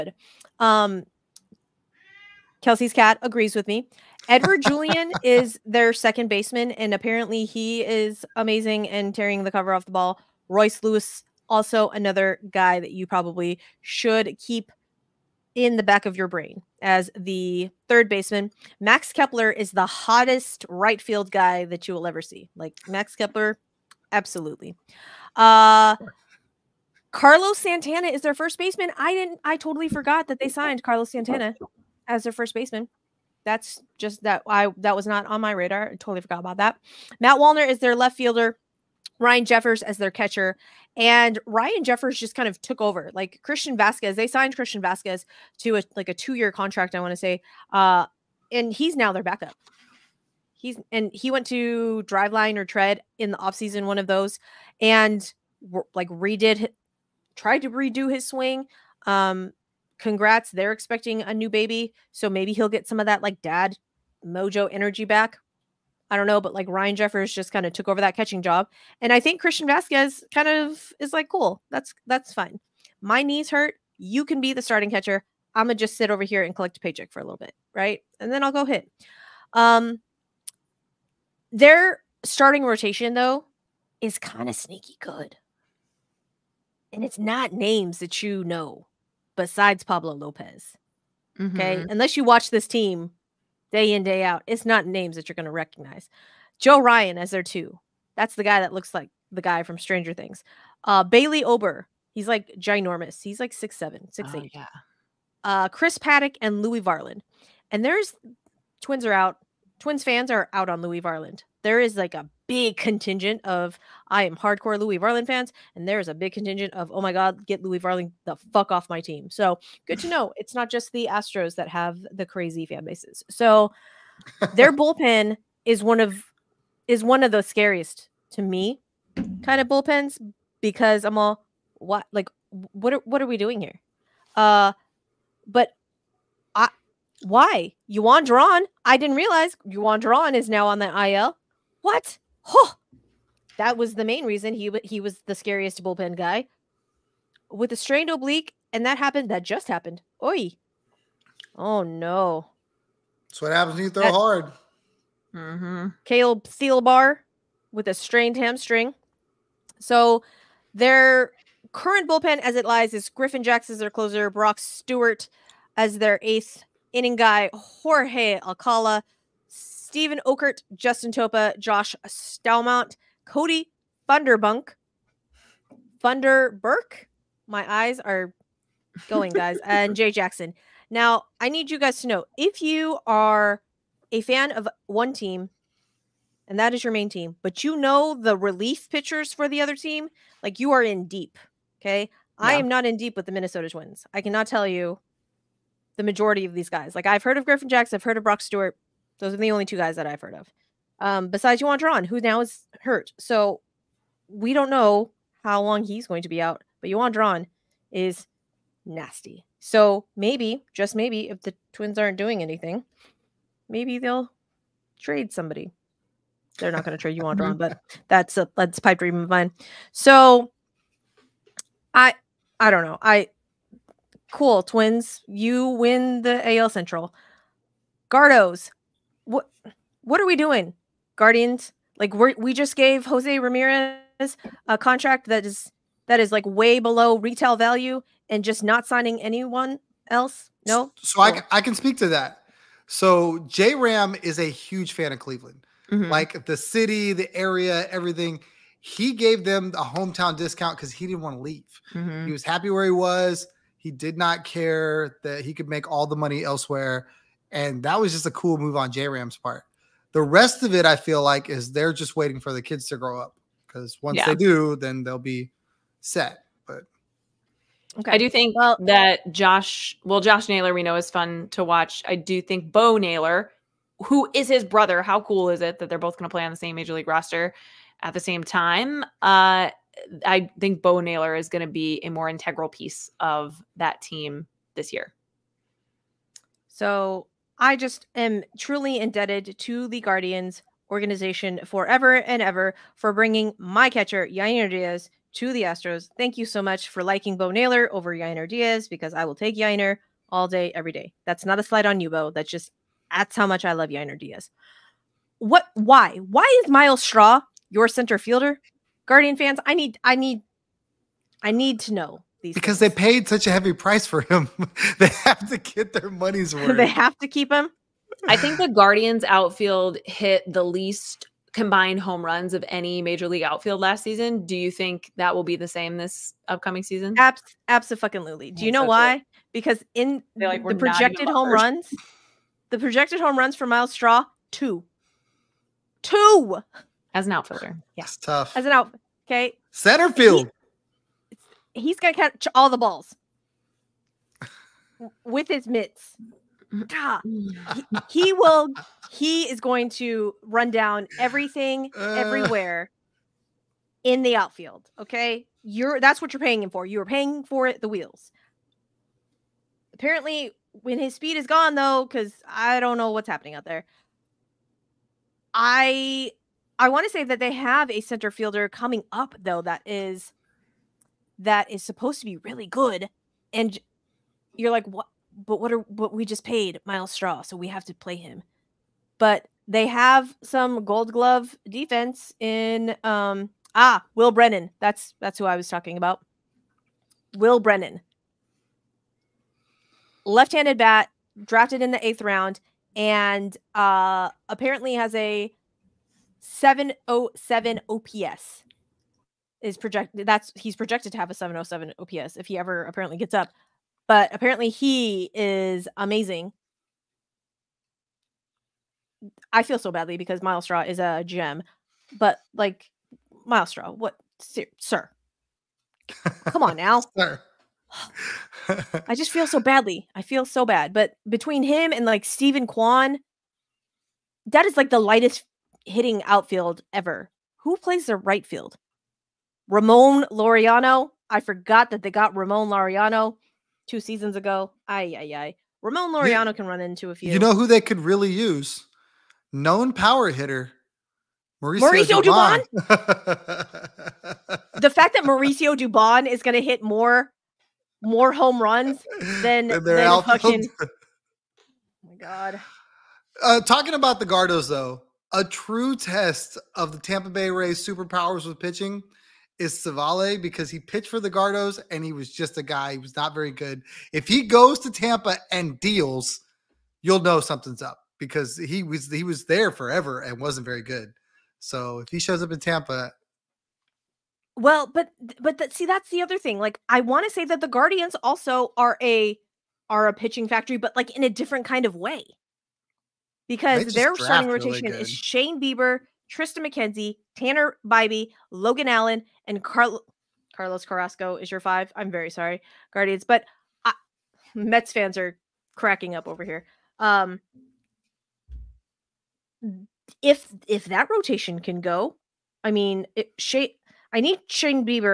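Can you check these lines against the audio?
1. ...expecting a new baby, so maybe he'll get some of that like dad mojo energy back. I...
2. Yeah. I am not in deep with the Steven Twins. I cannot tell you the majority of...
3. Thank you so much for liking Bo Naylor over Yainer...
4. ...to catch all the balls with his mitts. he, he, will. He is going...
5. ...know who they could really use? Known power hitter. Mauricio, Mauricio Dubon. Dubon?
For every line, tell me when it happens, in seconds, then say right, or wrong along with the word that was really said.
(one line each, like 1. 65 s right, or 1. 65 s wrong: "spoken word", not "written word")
1. 60 s right
2. 192 s wrong: "Minnesota", not "Steven"
3. 296 s right
4. 342 s right
5. 437 s right.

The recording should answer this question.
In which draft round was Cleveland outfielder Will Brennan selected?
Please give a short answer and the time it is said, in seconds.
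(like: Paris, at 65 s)
eighth round, at 392 s.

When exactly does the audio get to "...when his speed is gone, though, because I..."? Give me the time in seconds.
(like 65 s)
360 s.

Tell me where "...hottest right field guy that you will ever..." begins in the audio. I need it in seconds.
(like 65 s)
19 s.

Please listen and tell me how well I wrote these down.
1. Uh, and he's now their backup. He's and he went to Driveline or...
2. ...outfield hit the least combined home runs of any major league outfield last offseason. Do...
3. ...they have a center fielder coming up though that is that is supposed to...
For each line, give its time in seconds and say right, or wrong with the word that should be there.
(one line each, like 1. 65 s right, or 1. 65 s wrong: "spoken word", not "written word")
1. 47 s right
2. 319 s wrong: "season", not "offseason"
3. 367 s right.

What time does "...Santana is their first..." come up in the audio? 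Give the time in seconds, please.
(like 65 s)
27 s.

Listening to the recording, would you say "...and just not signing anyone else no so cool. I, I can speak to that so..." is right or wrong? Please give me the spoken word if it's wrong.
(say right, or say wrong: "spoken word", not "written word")
right.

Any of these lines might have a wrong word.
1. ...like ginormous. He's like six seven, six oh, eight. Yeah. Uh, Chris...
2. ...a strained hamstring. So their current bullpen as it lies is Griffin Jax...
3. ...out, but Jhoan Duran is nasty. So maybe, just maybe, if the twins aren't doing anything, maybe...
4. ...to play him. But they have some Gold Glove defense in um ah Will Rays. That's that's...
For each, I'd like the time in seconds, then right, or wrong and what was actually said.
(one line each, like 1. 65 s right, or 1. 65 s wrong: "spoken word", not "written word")
1. 102 s right
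2. 157 s right
3. 206 s right
4. 377 s wrong: "Brennan", not "Rays".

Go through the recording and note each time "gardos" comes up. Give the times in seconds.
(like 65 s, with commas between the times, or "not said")
228 s, 454 s, 461 s.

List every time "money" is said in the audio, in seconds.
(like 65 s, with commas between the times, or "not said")
256 s, 316 s.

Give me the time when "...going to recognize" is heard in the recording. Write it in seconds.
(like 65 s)
95 s.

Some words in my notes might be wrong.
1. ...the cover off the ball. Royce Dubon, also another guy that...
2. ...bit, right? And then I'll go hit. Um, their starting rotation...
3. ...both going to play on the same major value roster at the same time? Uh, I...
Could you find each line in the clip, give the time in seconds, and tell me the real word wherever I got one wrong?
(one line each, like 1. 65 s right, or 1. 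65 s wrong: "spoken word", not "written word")
1. 9 s wrong: "Lewis", not "Dubon"
2. 77 s right
3. 275 s wrong: "league", not "value".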